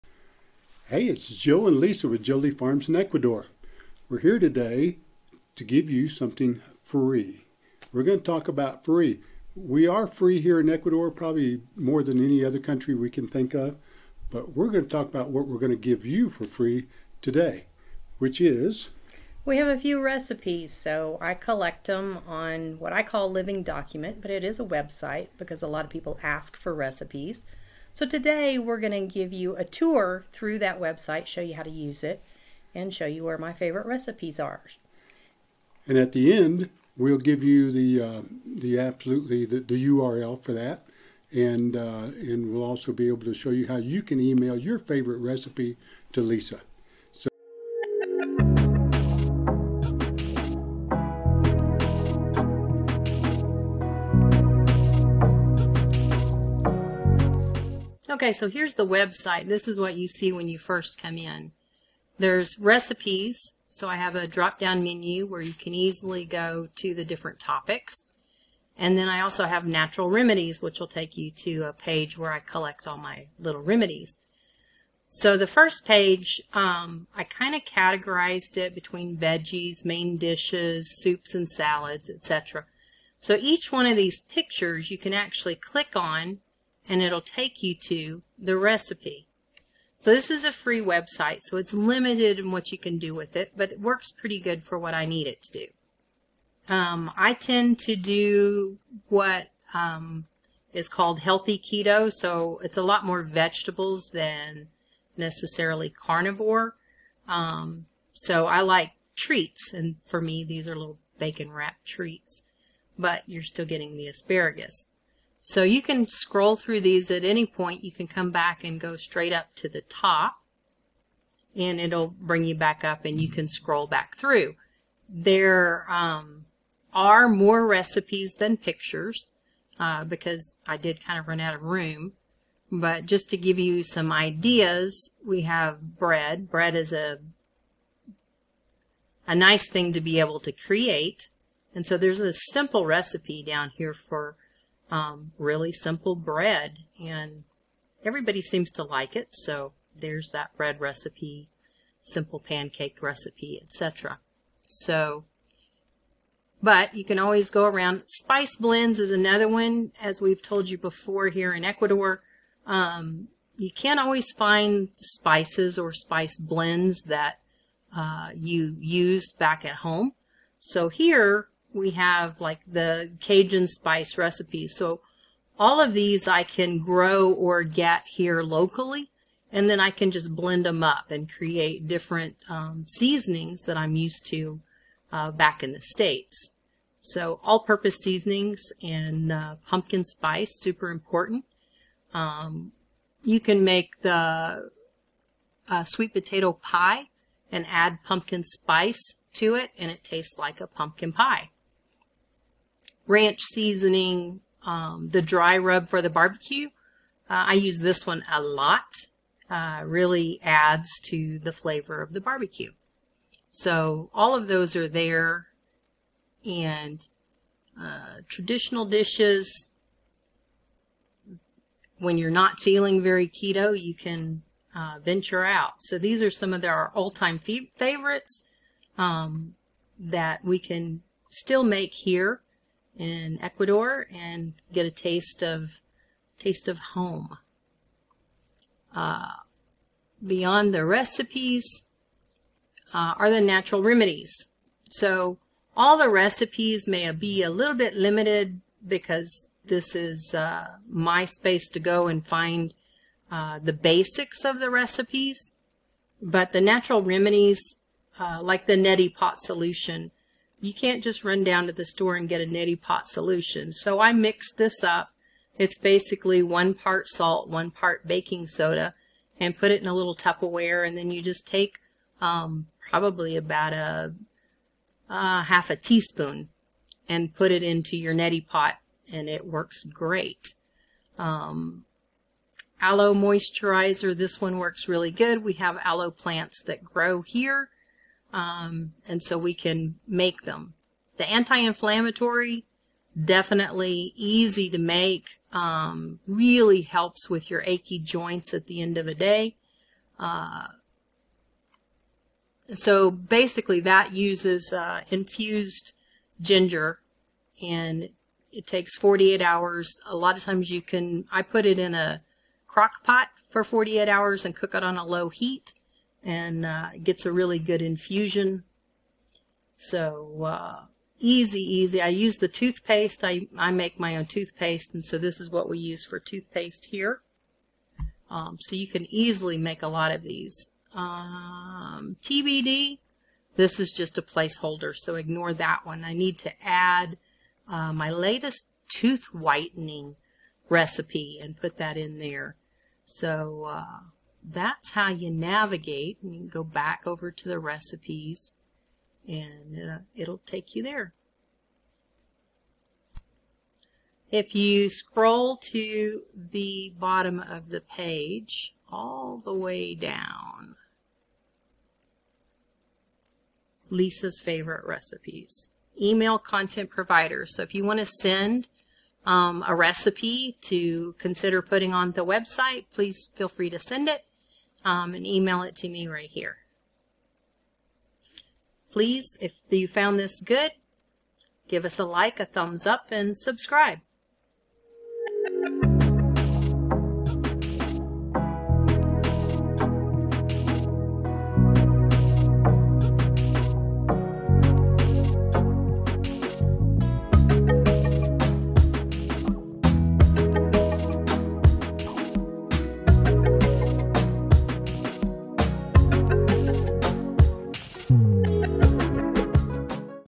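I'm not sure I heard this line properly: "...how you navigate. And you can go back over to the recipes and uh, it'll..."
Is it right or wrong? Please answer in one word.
right.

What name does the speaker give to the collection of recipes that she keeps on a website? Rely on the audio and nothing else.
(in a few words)
Living Document.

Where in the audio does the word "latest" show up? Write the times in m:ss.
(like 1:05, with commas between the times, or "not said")
5:38.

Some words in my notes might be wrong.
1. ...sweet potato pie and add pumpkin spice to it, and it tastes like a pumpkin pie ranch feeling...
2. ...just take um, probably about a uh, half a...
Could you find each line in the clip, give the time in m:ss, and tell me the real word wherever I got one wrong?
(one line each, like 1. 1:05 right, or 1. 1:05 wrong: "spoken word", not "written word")
1. 3:15 wrong: "seasoning", not "feeling"
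2. 4:31 right.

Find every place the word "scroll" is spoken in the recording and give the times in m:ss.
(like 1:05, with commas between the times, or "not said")
1:56, 2:03, 5:54.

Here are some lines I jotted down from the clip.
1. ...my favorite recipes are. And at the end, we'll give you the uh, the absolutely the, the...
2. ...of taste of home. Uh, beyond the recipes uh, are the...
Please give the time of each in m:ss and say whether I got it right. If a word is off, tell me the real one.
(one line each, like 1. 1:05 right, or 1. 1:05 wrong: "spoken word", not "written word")
1. 0:33 right
2. 3:55 right.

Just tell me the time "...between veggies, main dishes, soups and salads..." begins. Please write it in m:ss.
1:18.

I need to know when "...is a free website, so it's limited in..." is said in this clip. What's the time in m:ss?
1:30.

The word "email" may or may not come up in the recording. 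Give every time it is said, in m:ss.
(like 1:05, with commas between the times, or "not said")
0:44, 6:06, 6:15.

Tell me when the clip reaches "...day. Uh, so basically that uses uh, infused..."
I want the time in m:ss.
4:59.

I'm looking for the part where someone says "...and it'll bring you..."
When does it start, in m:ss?
2:01.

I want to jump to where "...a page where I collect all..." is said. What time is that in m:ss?
1:11.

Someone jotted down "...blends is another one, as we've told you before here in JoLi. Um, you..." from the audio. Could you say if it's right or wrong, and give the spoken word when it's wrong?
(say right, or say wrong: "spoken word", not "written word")
wrong: "Ecuador", not "JoLi".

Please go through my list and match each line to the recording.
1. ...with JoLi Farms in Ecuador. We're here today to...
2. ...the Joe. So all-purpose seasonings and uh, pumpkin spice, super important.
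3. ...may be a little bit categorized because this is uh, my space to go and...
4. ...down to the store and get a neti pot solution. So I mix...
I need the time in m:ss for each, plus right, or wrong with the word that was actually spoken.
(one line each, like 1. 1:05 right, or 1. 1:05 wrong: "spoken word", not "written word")
1. 0:02 right
2. 3:05 wrong: "States", not "Joe"
3. 4:06 wrong: "limited", not "categorized"
4. 4:21 right.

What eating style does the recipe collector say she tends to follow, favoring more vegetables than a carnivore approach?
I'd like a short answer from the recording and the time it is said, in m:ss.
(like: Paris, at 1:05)
healthy keto, at 1:41.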